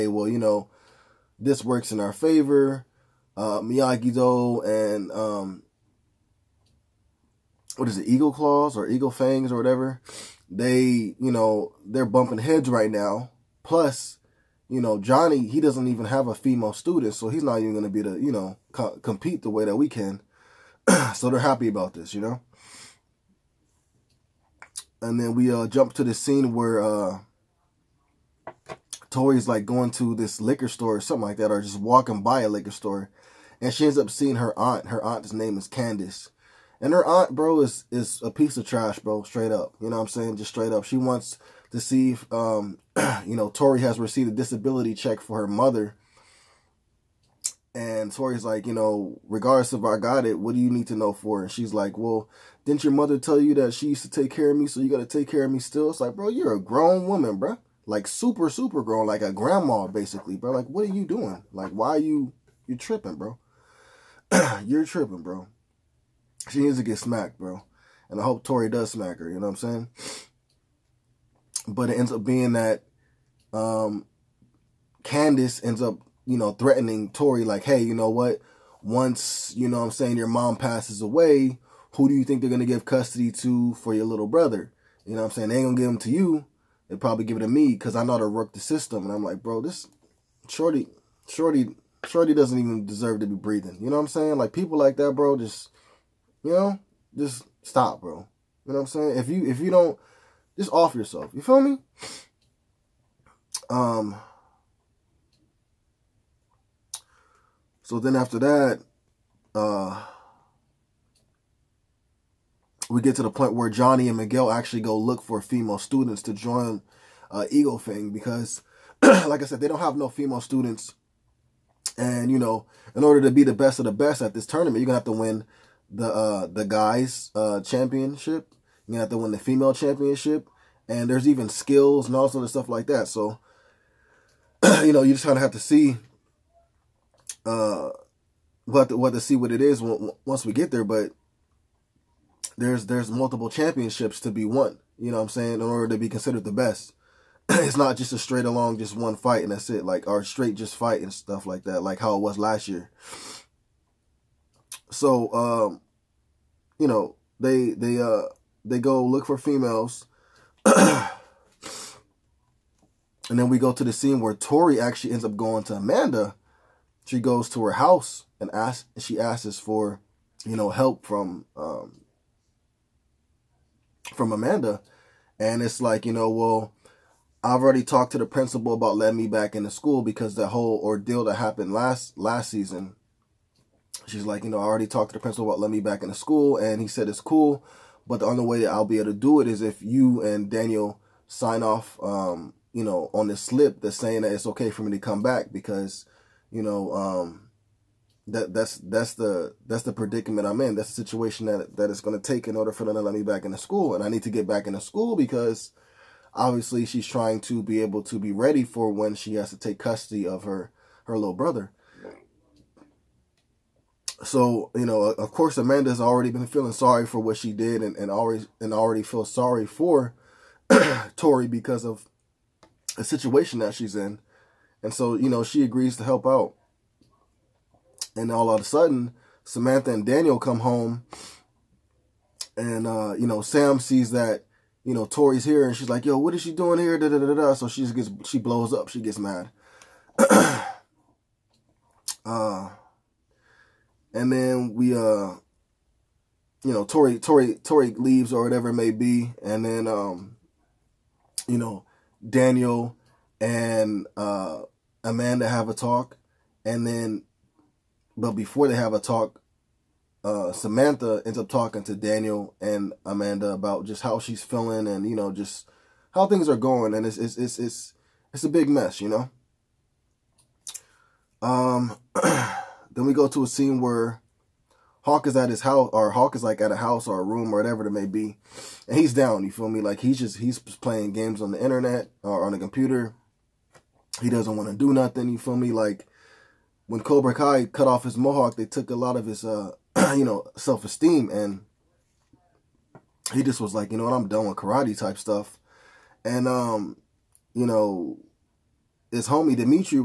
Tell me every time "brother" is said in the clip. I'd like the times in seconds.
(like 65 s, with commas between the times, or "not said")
84 s, 211 s.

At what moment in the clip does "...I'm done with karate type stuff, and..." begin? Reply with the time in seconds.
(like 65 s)
294 s.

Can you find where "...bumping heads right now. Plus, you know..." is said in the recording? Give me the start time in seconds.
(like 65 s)
12 s.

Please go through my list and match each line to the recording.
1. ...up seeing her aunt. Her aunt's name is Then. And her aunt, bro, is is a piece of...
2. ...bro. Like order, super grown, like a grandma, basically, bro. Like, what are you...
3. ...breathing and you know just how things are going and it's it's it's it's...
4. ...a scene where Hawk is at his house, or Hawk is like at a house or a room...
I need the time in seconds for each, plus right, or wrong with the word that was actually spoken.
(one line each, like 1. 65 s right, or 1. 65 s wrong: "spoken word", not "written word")
1. 33 s wrong: "Candace", not "Then"
2. 57 s wrong: "super", not "order"
3. 264 s wrong: "feeling", not "breathing"
4. 273 s right.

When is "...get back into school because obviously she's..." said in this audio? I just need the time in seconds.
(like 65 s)
204 s.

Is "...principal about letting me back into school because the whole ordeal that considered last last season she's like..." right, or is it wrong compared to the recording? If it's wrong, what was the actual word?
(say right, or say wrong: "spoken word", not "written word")
wrong: "happened", not "considered".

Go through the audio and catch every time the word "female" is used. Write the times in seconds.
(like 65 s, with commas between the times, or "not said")
16 s, 115 s, 120 s, 129 s, 159 s.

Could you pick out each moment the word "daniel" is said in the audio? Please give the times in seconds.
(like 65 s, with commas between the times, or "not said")
190 s, 230 s, 252 s, 261 s.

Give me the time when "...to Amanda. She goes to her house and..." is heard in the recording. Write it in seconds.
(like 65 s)
165 s.